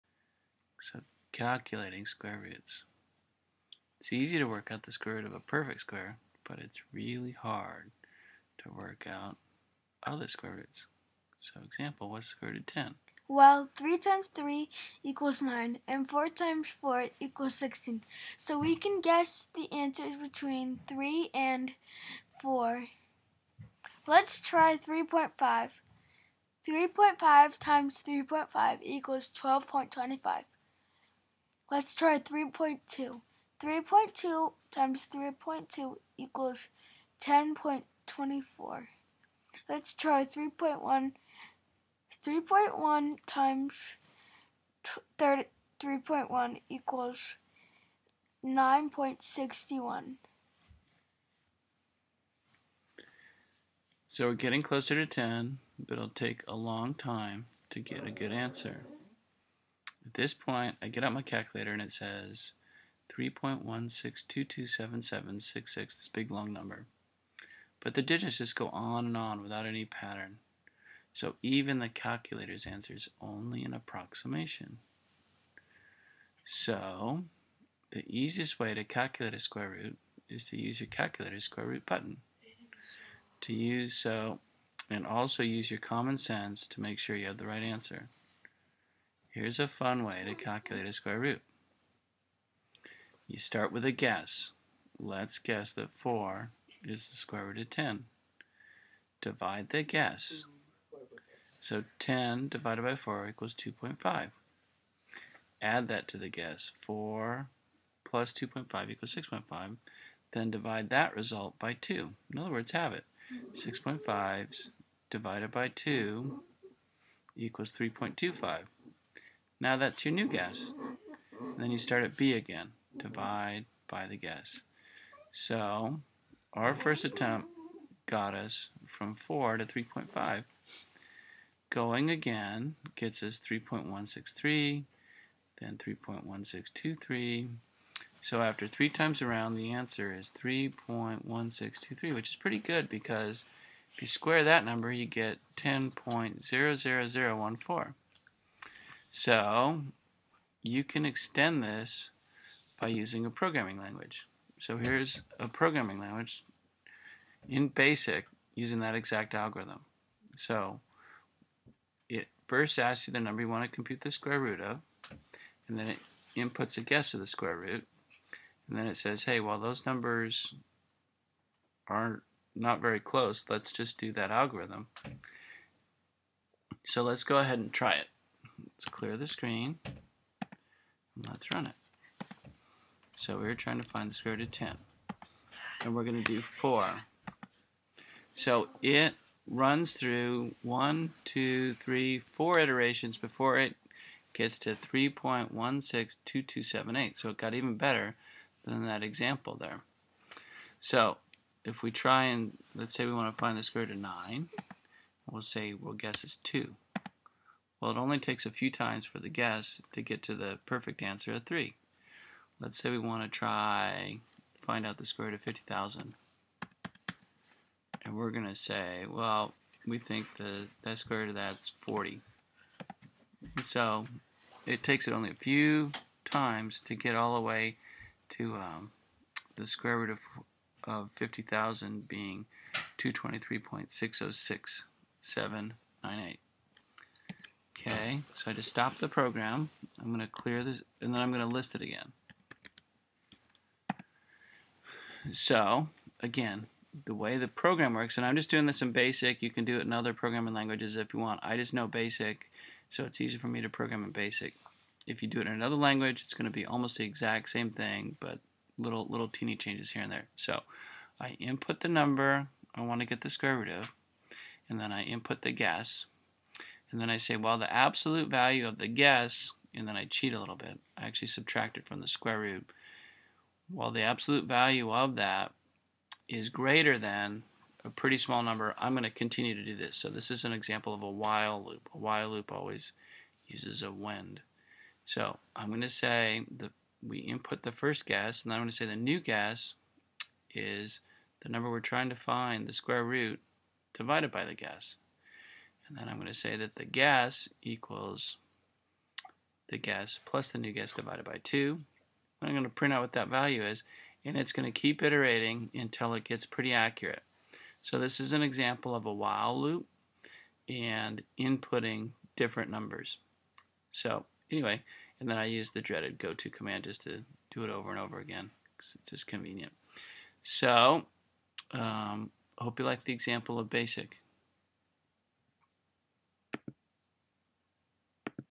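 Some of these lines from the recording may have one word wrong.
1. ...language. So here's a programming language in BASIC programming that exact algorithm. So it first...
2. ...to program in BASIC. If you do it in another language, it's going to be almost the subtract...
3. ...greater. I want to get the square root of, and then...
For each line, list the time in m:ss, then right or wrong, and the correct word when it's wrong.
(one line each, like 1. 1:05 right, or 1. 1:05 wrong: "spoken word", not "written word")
1. 2:33 wrong: "using", not "programming"
2. 4:13 wrong: "exact", not "subtract"
3. 4:21 wrong: "number", not "greater".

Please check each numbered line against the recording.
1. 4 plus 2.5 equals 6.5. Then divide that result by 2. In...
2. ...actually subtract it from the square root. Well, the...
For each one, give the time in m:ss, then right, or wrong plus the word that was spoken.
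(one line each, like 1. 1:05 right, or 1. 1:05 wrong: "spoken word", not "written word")
1. 1:46 right
2. 4:31 right.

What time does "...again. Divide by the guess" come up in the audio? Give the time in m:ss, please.
2:02.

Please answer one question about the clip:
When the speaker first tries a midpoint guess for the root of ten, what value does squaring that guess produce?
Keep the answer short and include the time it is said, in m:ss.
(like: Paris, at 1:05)
12.25, at 0:29.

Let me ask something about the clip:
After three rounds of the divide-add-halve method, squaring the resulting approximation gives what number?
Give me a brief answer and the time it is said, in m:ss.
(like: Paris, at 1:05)
10.00014, at 2:25.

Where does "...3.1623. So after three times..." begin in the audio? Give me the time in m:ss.
2:15.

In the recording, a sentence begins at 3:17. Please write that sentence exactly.
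So it got even better than that example there.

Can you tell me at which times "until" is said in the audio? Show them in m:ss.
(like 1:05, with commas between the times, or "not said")
5:05.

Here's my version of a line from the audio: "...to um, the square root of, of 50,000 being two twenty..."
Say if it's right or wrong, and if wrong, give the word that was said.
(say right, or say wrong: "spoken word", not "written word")
right.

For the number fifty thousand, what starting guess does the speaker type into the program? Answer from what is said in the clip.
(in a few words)
40.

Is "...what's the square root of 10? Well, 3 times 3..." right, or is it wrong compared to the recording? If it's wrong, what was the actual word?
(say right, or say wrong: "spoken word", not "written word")
right.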